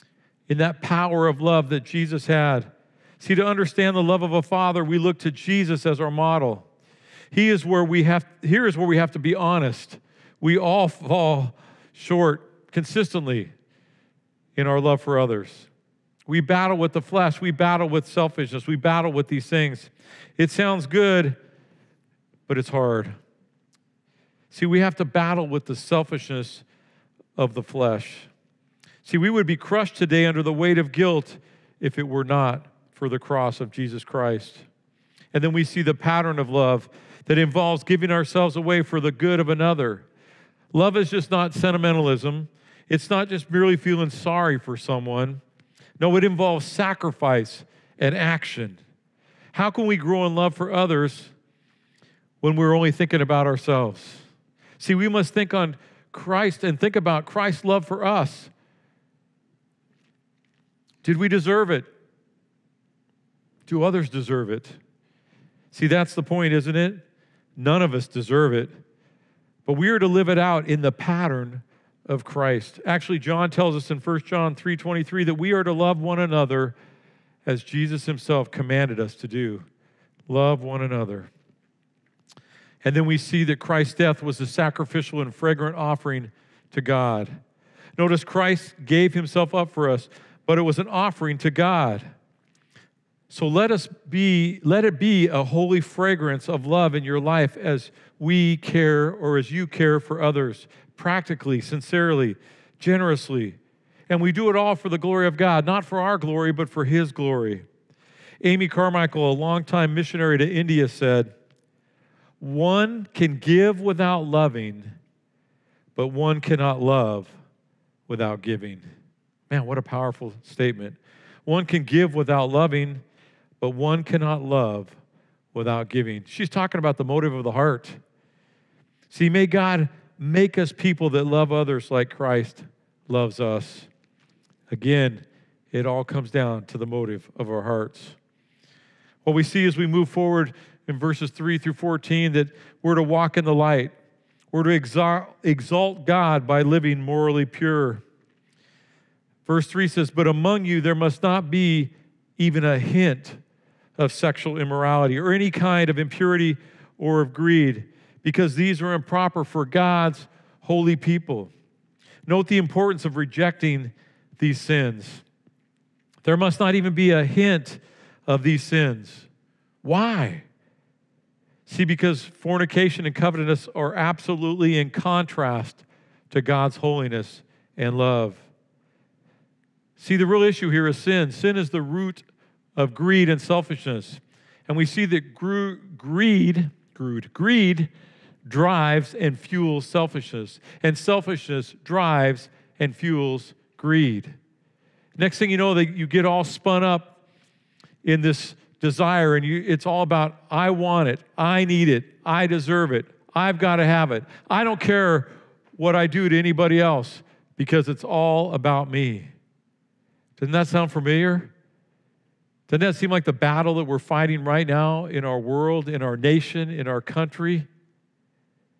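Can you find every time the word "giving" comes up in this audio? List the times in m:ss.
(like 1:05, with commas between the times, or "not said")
0:37, 1:58, 2:05.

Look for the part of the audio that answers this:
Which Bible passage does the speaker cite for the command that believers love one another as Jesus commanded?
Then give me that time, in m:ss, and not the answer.
1:13.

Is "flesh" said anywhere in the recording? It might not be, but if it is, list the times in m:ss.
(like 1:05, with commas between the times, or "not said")
0:16, 0:27.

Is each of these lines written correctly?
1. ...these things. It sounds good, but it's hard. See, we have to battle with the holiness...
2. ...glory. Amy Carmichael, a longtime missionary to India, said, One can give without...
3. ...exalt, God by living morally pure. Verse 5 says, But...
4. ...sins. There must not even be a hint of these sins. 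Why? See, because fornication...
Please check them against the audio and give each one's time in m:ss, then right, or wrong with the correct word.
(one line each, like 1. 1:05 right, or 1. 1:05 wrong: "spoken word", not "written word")
1. 0:19 wrong: "selfishness", not "holiness"
2. 1:47 right
3. 2:25 wrong: "3", not "5"
4. 2:44 right.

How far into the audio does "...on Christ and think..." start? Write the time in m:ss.
0:55.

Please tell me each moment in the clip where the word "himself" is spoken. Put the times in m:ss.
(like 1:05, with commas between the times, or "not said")
1:18, 1:29.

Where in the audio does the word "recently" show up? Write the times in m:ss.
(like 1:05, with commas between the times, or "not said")
not said.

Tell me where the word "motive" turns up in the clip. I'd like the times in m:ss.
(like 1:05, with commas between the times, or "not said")
2:07, 2:16.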